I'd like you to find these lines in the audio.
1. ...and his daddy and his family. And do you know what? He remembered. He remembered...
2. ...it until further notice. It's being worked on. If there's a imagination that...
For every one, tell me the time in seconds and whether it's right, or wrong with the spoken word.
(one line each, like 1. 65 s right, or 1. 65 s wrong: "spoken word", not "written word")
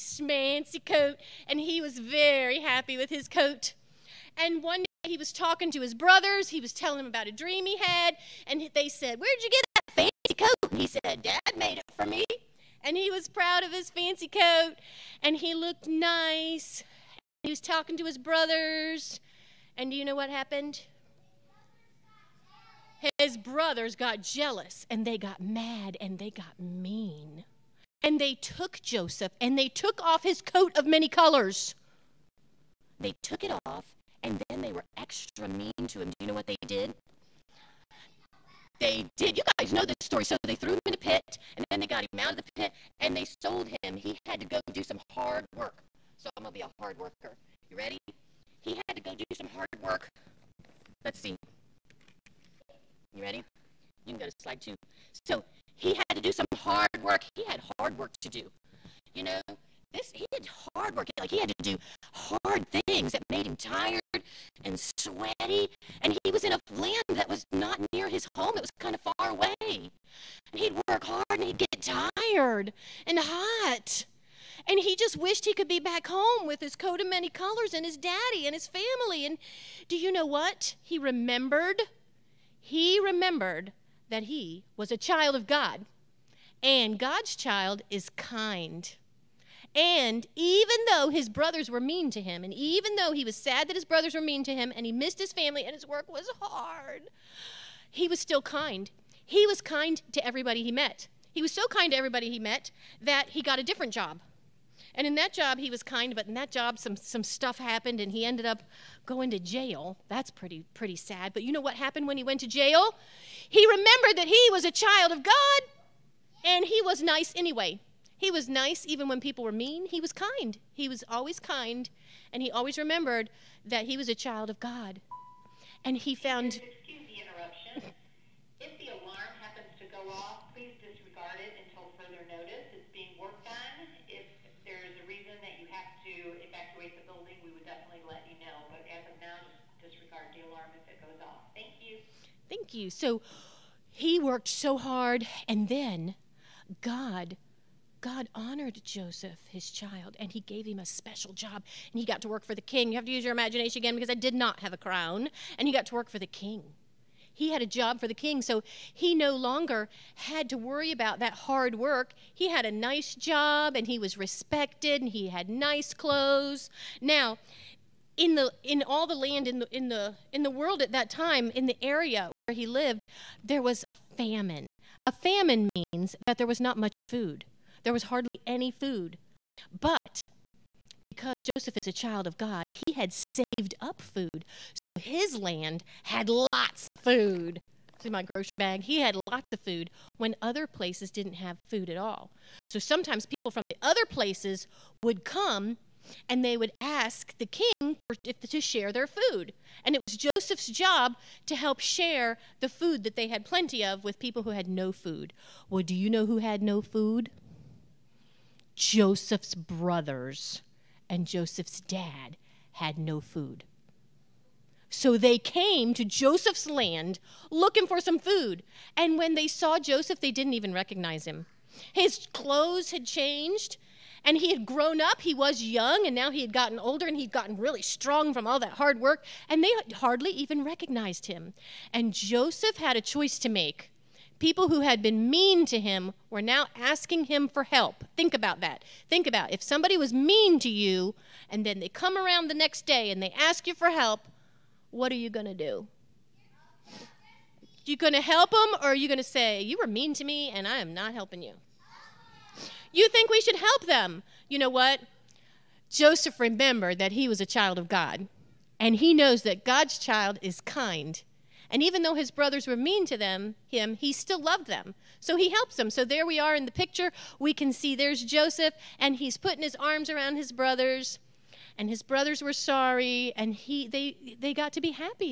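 1. 77 s right
2. 131 s wrong: "reason", not "imagination".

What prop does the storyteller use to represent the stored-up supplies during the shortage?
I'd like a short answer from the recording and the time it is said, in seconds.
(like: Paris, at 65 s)
Grocery bag, at 188 s.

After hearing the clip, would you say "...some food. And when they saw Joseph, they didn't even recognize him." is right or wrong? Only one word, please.
right.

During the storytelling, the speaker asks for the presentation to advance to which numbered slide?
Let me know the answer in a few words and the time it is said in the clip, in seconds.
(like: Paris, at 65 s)
Slide two, at 54 s.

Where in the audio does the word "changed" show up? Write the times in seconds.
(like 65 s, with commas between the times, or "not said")
223 s.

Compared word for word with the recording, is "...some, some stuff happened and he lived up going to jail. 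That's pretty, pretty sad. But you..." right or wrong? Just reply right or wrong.
wrong.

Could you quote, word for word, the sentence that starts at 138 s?
But as of now, just disregard the alarm if it goes off.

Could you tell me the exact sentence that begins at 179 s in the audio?
But because Joseph is a child of God, he had saved up food.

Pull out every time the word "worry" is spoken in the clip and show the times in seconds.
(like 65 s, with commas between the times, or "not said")
160 s.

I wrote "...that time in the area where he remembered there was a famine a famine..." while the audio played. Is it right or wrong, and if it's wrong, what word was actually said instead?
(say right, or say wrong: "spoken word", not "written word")
wrong: "lived", not "remembered".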